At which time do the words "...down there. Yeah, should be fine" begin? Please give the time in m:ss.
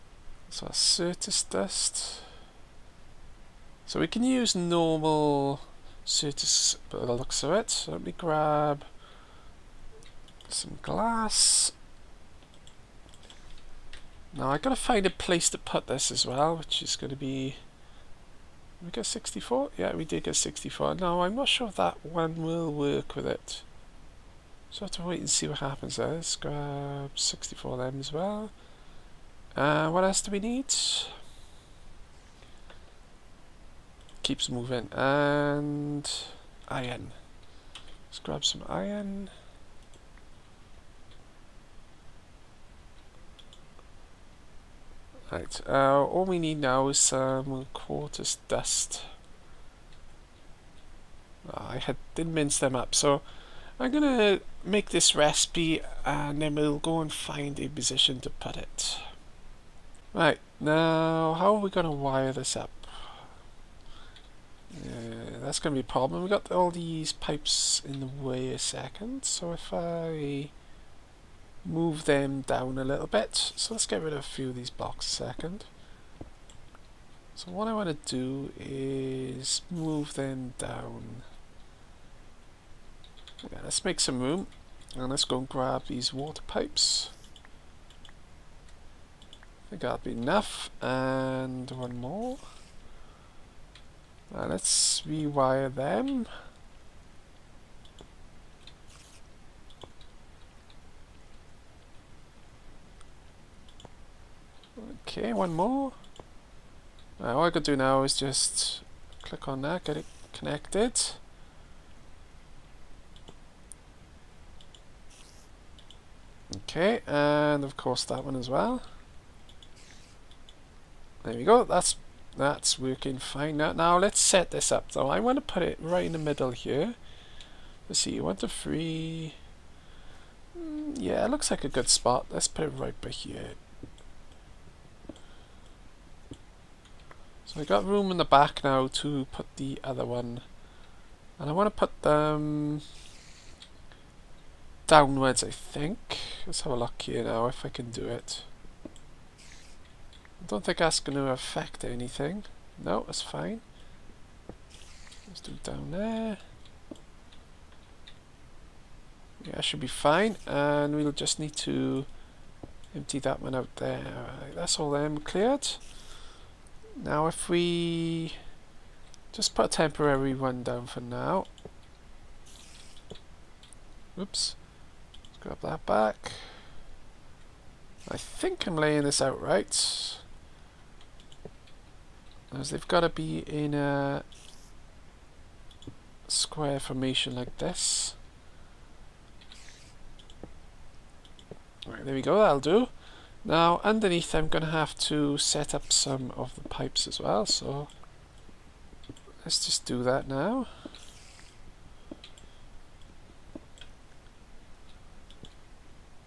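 2:35.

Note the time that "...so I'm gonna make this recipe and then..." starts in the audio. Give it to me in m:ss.
0:52.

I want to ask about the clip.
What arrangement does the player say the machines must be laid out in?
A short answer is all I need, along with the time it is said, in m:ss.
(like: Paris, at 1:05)
Square formation, at 3:06.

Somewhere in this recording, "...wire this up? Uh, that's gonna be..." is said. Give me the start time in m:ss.
1:01.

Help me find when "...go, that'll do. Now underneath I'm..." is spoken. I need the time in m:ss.
3:12.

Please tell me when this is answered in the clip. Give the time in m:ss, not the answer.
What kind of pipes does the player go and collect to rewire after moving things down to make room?
1:26.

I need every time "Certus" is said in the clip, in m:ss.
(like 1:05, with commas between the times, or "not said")
0:00, 0:06.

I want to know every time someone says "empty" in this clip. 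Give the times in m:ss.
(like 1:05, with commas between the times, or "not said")
2:42.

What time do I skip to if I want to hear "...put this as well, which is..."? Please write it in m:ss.
0:15.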